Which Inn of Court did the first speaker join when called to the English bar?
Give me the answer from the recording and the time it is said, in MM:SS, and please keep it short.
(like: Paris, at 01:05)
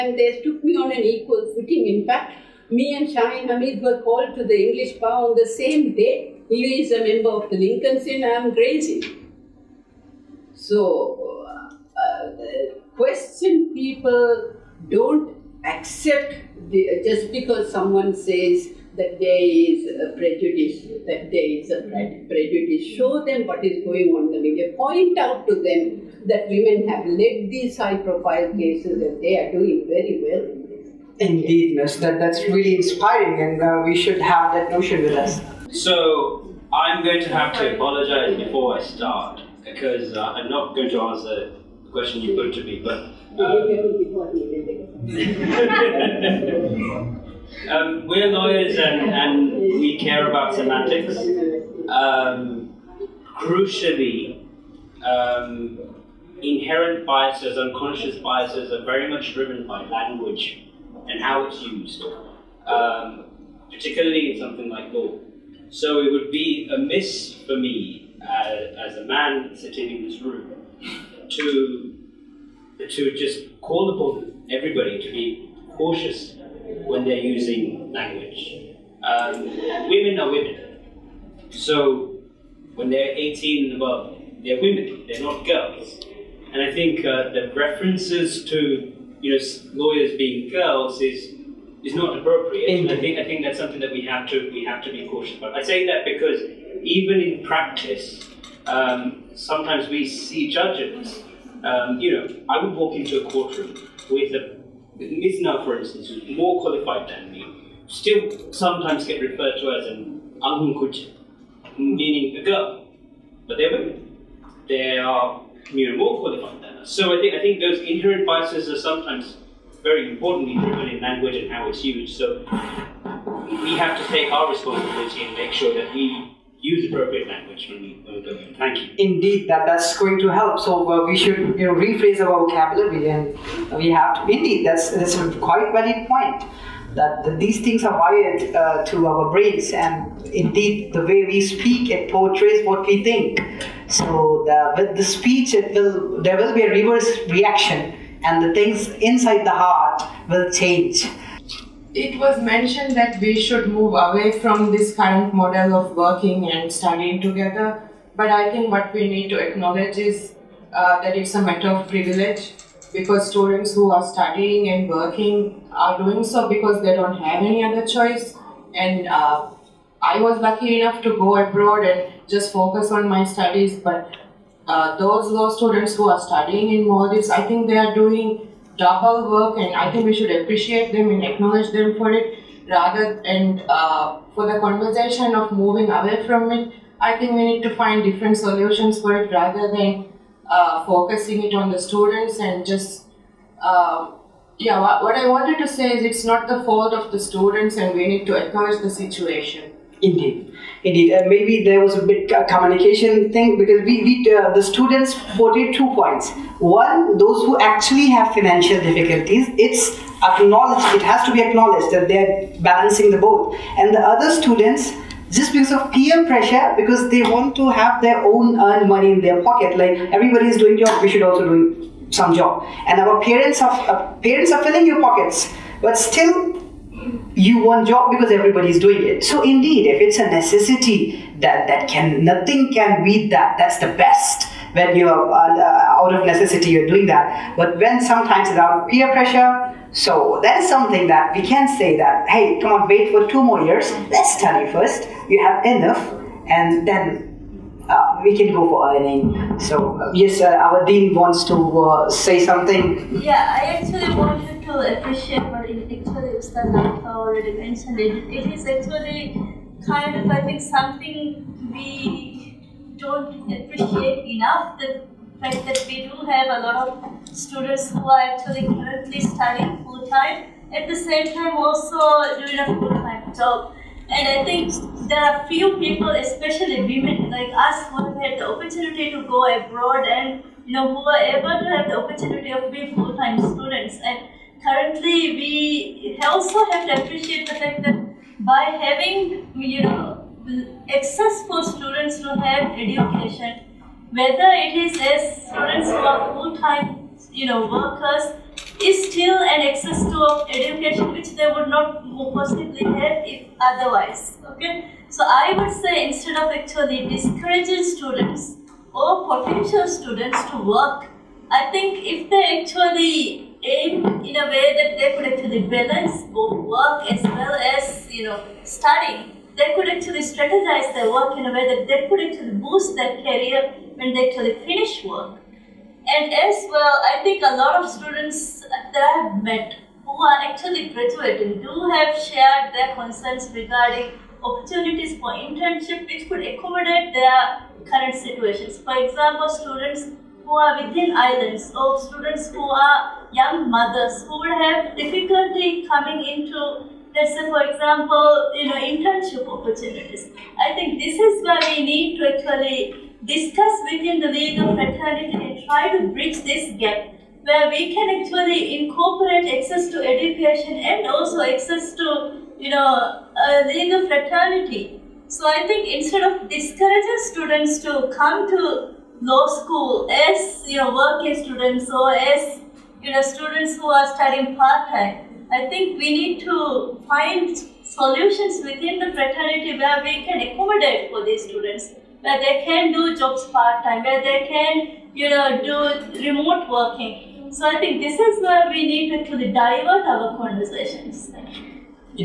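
Gray's Inn, at 00:08.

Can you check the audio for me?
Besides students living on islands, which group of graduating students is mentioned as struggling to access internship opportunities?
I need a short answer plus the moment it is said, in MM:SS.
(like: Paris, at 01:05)
young mothers, at 05:43.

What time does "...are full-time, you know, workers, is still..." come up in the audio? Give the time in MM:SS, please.
04:56.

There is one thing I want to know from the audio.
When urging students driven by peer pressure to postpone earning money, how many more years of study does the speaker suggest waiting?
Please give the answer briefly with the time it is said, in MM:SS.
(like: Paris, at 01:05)
2, at 04:03.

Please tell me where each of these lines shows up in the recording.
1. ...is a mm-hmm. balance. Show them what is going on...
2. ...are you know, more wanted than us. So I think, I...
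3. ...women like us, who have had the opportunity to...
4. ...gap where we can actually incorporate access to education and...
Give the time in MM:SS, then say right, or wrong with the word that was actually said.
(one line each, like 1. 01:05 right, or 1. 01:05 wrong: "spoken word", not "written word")
1. 00:21 wrong: "prejudice", not "balance"
2. 01:54 wrong: "qualified", not "wanted"
3. 04:36 right
4. 05:56 right.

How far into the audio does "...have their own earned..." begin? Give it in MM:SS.
03:37.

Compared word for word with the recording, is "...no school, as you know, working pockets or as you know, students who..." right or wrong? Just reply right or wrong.
wrong.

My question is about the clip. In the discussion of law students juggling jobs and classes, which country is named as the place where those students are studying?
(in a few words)
Maldives.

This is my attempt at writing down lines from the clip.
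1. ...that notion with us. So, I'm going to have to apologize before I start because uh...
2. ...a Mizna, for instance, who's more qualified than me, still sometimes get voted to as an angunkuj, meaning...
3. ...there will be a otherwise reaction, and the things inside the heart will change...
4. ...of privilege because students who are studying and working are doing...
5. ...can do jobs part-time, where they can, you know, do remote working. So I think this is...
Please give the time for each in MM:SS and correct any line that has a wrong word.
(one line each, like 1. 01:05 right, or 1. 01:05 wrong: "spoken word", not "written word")
1. 00:34 right
2. 01:44 wrong: "referred", not "voted"
3. 02:26 wrong: "reverse", not "otherwise"
4. 02:41 right
5. 06:22 right.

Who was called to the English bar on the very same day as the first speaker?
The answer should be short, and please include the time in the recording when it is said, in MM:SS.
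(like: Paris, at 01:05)
Shahin Hamid, at 00:03.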